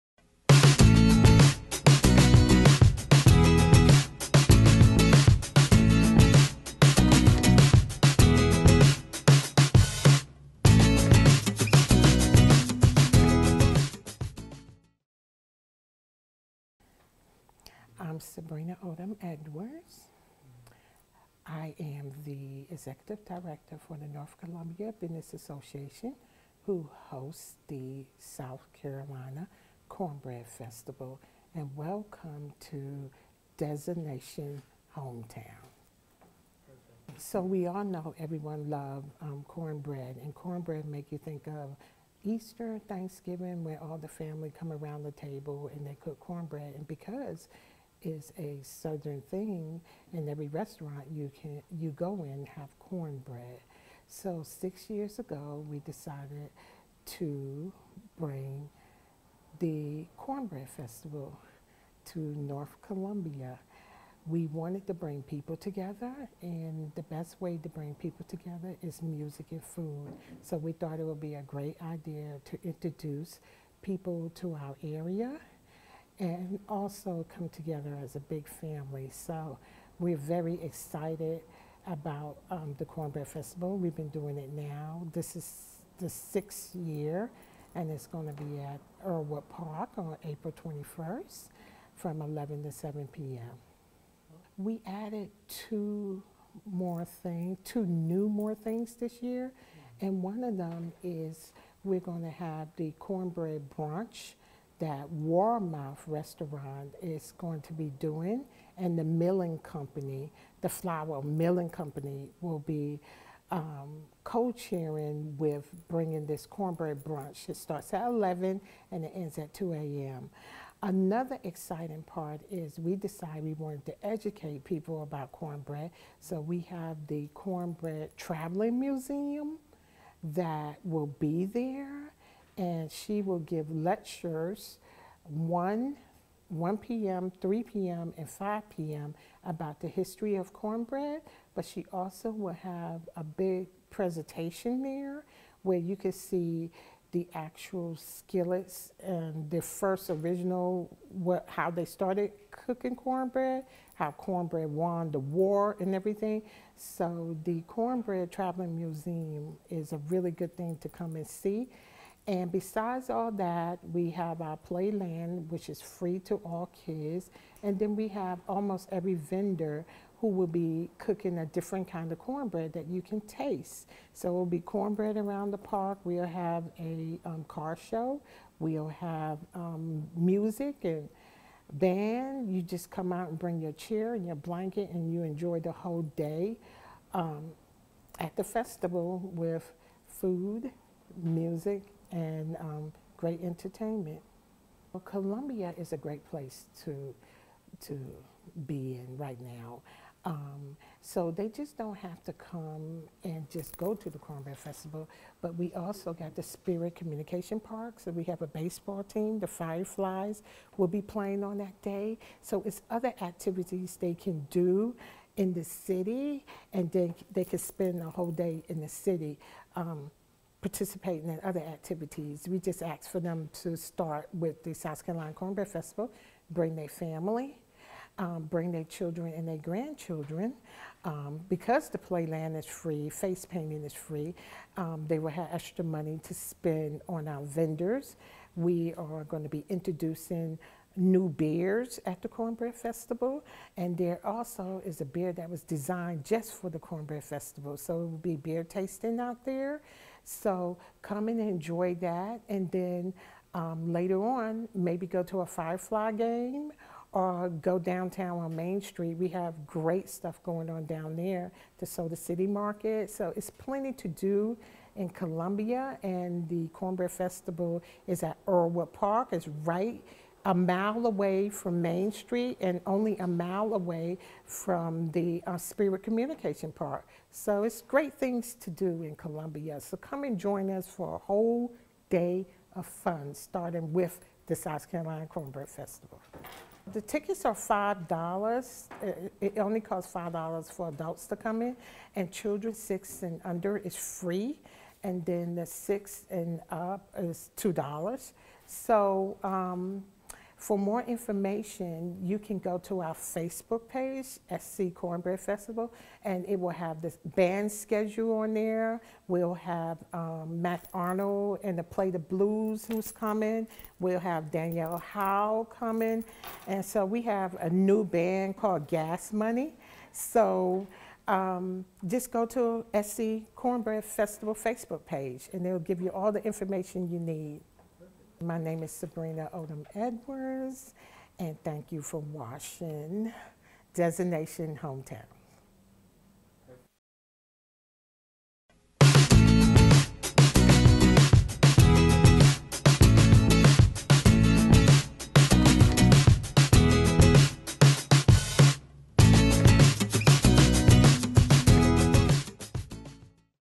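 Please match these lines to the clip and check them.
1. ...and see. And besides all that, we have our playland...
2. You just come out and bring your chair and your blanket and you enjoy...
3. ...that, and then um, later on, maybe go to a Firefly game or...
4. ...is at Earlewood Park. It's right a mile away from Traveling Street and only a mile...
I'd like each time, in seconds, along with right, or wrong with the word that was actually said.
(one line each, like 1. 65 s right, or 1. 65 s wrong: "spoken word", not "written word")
1. 161 s right
2. 182 s right
3. 252 s right
4. 268 s wrong: "Main", not "Traveling".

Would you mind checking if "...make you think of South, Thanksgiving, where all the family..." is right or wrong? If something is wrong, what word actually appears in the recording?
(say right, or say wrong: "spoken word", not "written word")
wrong: "Easter", not "South".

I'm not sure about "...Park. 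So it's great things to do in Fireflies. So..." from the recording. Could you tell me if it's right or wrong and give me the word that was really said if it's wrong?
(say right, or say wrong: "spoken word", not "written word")
wrong: "Columbia", not "Fireflies".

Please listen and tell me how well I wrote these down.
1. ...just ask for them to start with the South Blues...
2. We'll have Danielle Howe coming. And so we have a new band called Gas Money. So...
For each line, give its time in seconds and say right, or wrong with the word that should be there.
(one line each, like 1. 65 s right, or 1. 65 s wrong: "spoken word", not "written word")
1. 222 s wrong: "Carolina", not "Blues"
2. 313 s right.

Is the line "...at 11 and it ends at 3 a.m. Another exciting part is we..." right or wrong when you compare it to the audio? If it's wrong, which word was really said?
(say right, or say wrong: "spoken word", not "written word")
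wrong: "2", not "3".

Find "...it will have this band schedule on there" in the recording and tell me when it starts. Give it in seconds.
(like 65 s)
306 s.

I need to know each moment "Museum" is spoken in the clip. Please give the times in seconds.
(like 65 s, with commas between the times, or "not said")
128 s, 158 s.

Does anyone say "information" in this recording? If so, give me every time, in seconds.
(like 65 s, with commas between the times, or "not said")
301 s, 326 s.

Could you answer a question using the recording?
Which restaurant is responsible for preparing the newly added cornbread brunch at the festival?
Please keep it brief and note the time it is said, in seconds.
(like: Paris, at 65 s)
Warmouth Restaurant, at 105 s.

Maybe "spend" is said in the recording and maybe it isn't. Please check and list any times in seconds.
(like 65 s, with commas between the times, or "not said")
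217 s, 236 s.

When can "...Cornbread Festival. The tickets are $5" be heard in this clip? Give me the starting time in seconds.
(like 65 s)
285 s.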